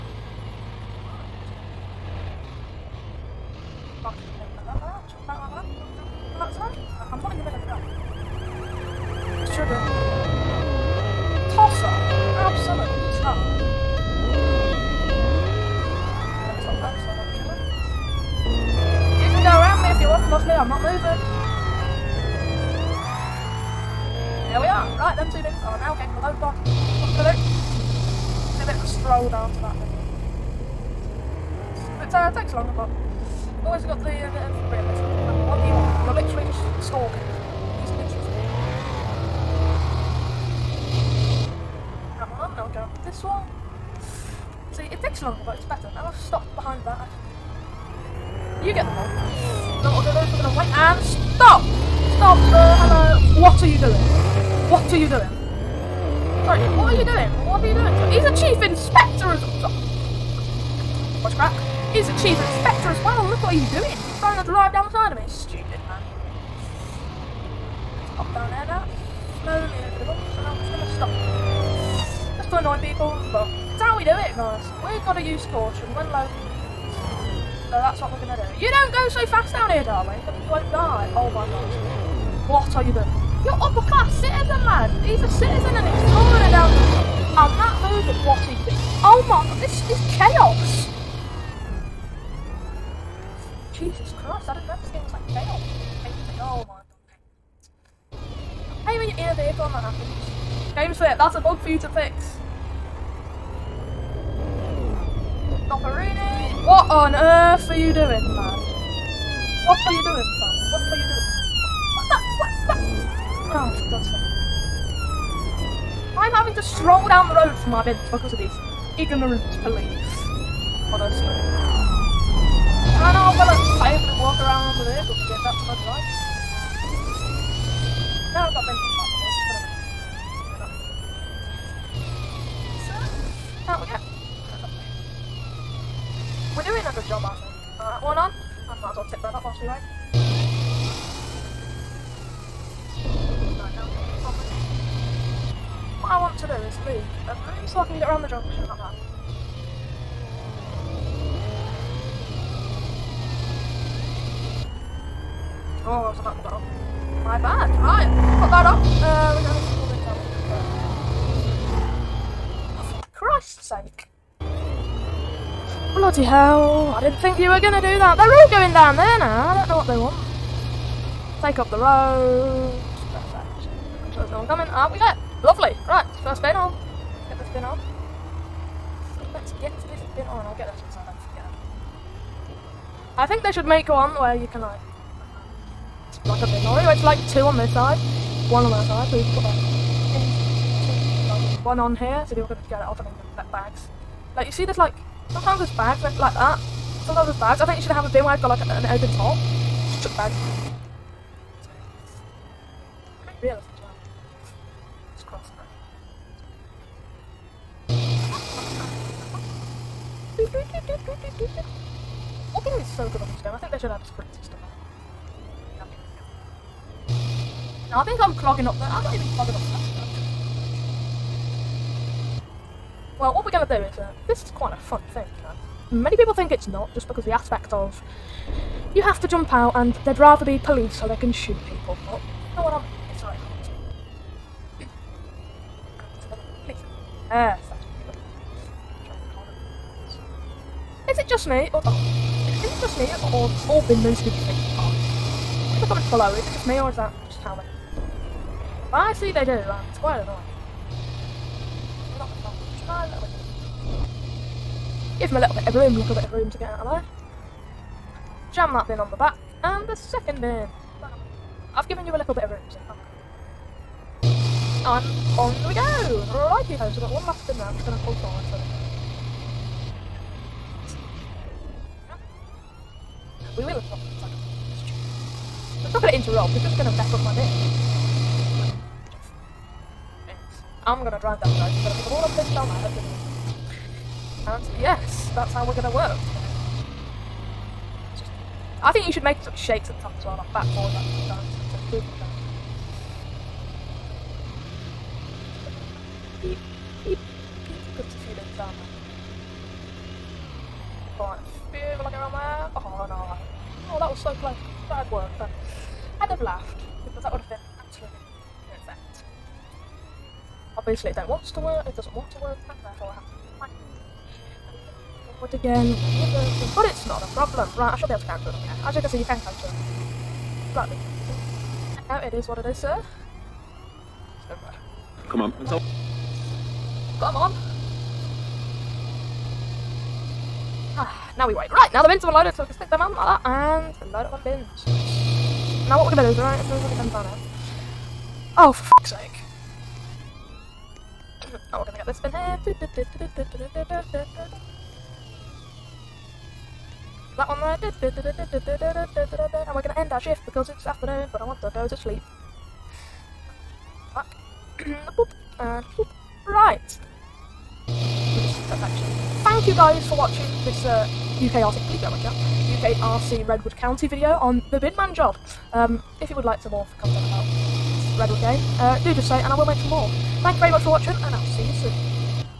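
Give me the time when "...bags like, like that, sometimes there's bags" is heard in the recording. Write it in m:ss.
3:15.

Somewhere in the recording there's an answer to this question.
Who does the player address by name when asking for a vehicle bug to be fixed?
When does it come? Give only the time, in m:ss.
1:40.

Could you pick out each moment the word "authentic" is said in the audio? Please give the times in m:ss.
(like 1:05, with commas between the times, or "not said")
not said.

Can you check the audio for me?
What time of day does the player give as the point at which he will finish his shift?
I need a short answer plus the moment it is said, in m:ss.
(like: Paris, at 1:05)
Afternoon, at 5:50.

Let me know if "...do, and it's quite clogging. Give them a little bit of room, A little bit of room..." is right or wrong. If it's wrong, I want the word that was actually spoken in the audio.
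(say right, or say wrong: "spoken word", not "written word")
wrong: "annoying", not "clogging".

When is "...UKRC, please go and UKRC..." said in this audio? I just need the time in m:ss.
6:01.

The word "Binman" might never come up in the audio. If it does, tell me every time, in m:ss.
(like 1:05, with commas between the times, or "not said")
6:04.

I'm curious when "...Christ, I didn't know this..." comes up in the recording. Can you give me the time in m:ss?
1:34.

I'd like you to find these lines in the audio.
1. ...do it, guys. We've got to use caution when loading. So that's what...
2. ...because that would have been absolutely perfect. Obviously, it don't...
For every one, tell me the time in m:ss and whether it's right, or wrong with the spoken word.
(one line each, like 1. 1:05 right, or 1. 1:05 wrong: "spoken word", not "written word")
1. 1:14 right
2. 5:07 right.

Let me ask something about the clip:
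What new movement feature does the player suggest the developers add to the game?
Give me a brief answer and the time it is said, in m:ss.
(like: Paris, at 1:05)
A sprint system, at 3:34.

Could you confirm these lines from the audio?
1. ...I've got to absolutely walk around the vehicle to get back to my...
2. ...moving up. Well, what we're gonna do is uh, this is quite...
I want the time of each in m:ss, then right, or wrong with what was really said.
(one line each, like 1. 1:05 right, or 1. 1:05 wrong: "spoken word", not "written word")
1. 2:03 wrong: "safely", not "absolutely"
2. 3:39 wrong: "clogging", not "moving".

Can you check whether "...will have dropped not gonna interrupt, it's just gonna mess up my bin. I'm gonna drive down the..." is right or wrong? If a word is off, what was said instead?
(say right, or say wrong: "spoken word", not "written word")
right.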